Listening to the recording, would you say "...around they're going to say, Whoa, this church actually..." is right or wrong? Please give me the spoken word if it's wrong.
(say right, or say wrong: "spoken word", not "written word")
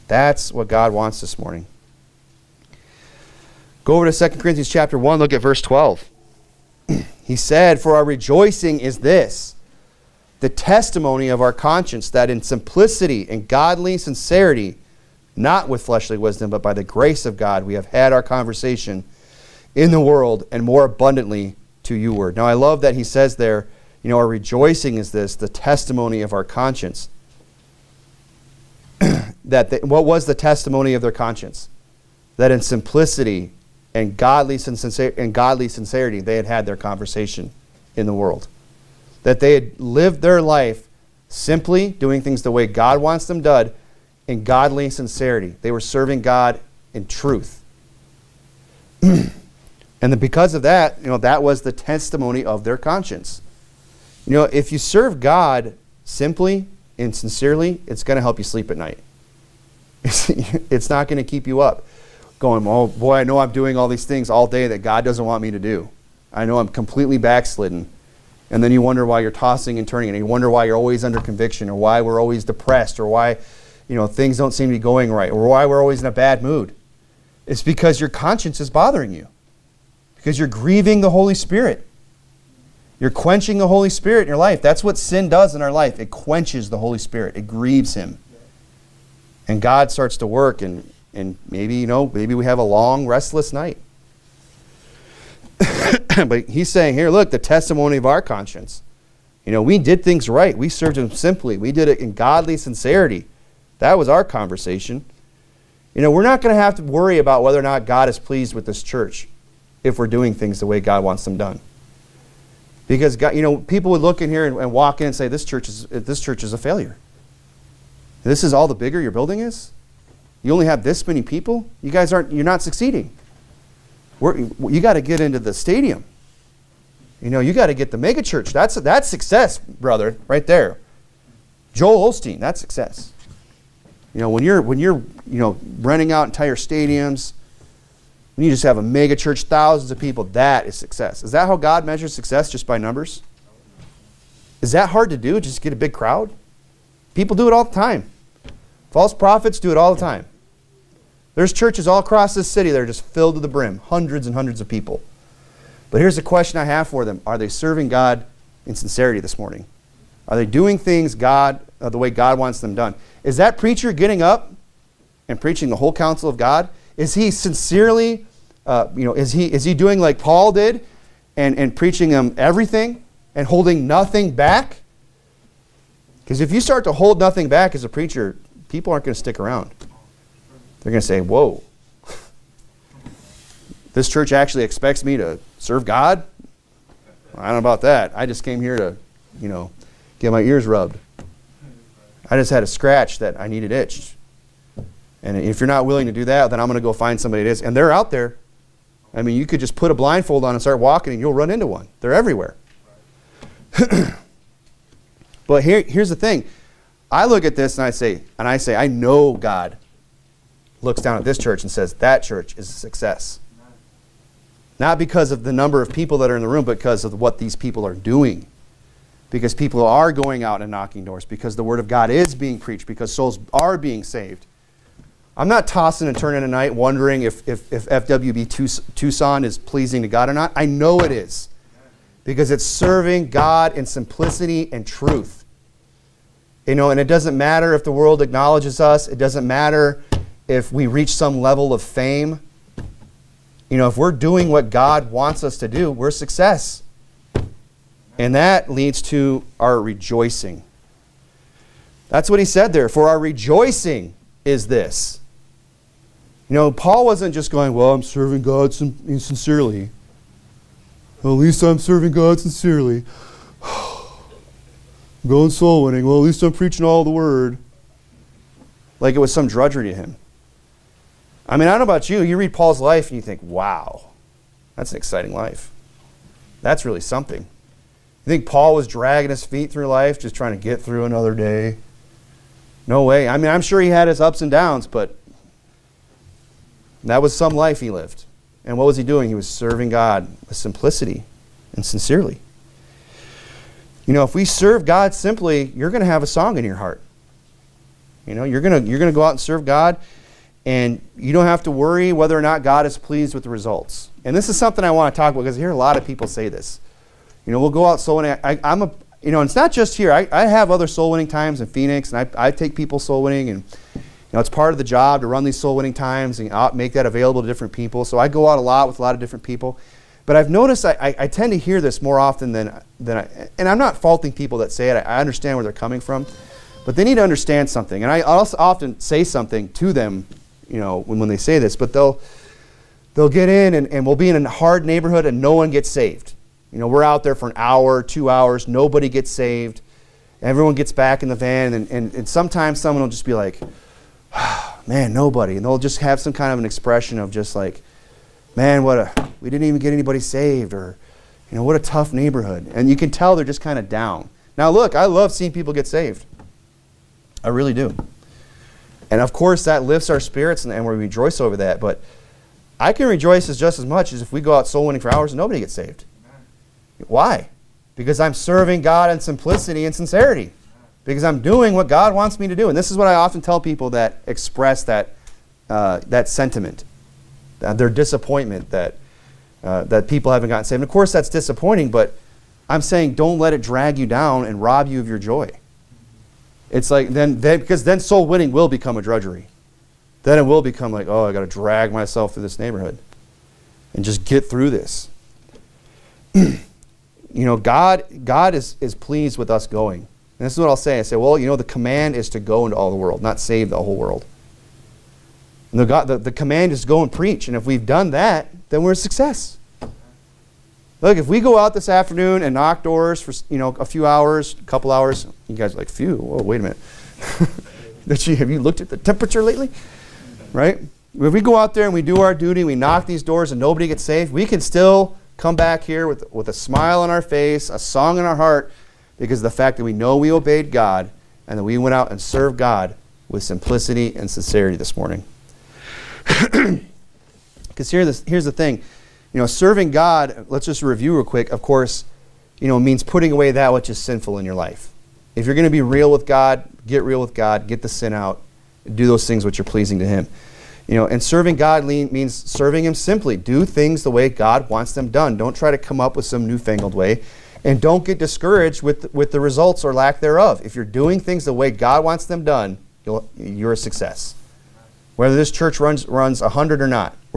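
right.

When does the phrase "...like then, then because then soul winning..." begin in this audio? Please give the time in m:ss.
6:26.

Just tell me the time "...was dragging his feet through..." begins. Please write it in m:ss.
4:38.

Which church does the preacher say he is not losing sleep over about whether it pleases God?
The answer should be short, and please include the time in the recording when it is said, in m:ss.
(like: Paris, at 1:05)
FWB Tucson, at 3:47.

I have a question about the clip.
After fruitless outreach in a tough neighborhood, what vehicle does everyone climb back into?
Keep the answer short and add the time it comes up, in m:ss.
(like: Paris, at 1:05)
the van, at 5:41.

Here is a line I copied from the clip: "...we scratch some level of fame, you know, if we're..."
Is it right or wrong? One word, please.
wrong.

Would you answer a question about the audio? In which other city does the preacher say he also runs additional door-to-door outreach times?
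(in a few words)
Phoenix.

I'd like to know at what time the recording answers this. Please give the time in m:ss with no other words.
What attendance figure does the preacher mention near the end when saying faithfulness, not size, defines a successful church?
7:46.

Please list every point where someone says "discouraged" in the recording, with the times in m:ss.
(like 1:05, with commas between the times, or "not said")
7:38.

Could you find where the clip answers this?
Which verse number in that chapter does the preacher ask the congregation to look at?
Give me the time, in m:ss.
0:05.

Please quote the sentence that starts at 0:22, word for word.
Now, I love that he says there, you know, our rejoicing is this, the testimony of our conscience.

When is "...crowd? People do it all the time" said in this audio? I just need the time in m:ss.
2:25.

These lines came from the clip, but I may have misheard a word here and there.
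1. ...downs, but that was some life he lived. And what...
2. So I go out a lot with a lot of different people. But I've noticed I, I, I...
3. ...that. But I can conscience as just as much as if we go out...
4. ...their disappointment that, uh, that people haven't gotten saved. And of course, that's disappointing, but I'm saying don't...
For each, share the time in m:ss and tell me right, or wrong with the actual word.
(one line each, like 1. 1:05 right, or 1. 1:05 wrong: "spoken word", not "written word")
1. 4:44 right
2. 5:18 right
3. 6:01 wrong: "rejoice", not "conscience"
4. 6:17 right.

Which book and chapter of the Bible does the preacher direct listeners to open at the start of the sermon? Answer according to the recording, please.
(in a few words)
2 Corinthians 1.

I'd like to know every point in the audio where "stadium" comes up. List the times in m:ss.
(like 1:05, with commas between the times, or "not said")
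2:05, 2:16.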